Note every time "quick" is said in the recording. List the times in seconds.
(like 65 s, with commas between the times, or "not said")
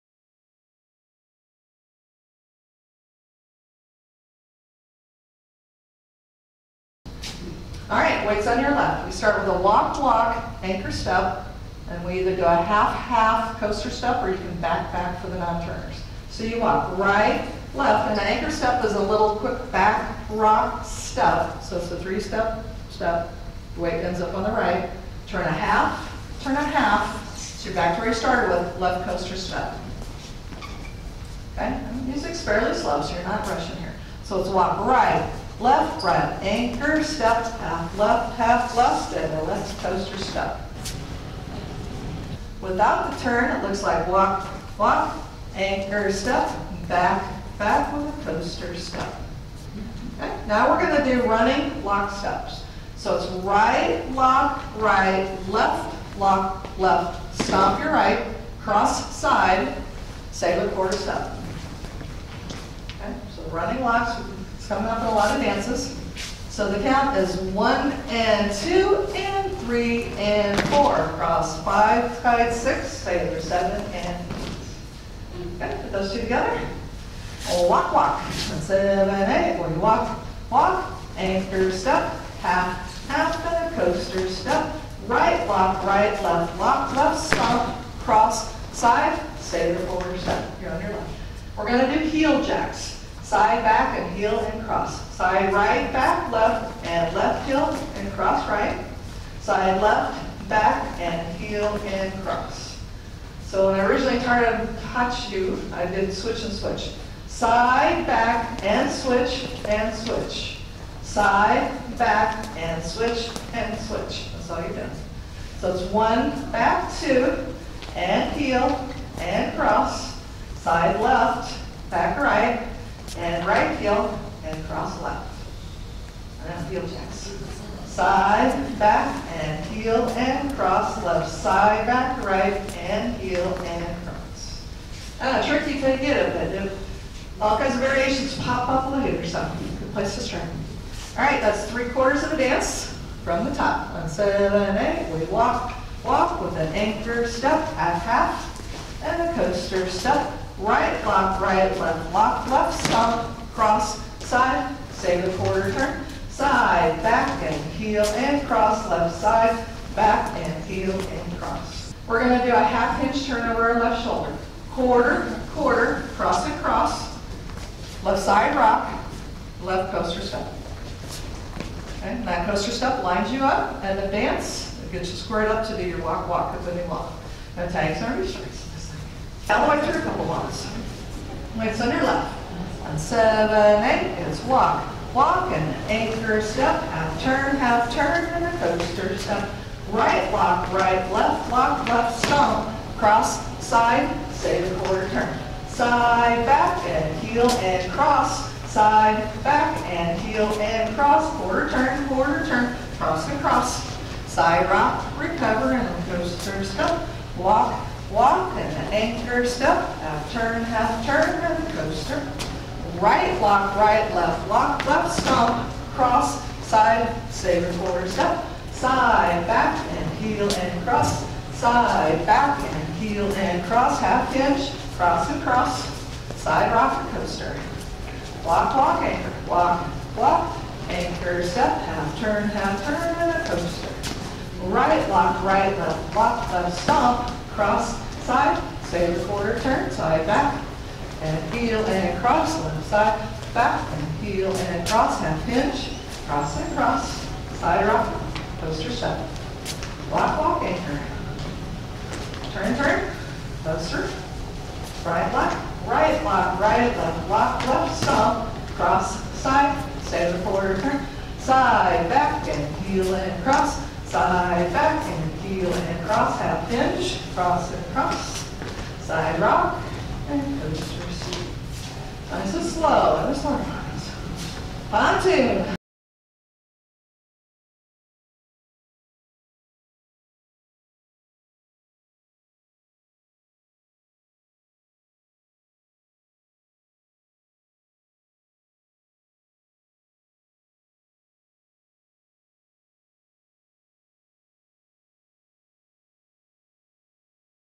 19 s.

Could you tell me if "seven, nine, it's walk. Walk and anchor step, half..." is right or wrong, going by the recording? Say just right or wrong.
wrong.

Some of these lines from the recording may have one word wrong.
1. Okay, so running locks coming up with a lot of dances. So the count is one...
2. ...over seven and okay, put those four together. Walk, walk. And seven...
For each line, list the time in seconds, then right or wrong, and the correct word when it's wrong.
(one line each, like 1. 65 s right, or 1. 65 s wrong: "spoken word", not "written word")
1. 62 s right
2. 73 s wrong: "two", not "four".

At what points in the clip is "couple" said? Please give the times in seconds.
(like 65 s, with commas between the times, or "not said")
180 s.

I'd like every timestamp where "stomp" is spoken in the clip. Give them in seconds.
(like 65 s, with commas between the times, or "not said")
192 s, 215 s, 236 s.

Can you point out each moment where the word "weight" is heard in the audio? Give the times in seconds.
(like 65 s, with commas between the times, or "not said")
8 s, 23 s.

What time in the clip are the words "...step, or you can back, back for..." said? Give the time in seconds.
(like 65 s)
13 s.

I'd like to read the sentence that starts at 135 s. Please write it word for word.
Uh, tricky to get it, but if all kinds of variations pop up, look at yourself.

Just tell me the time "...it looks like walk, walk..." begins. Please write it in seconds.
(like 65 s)
43 s.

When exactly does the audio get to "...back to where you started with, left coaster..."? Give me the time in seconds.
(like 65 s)
27 s.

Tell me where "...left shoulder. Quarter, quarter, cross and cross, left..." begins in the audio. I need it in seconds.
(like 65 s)
163 s.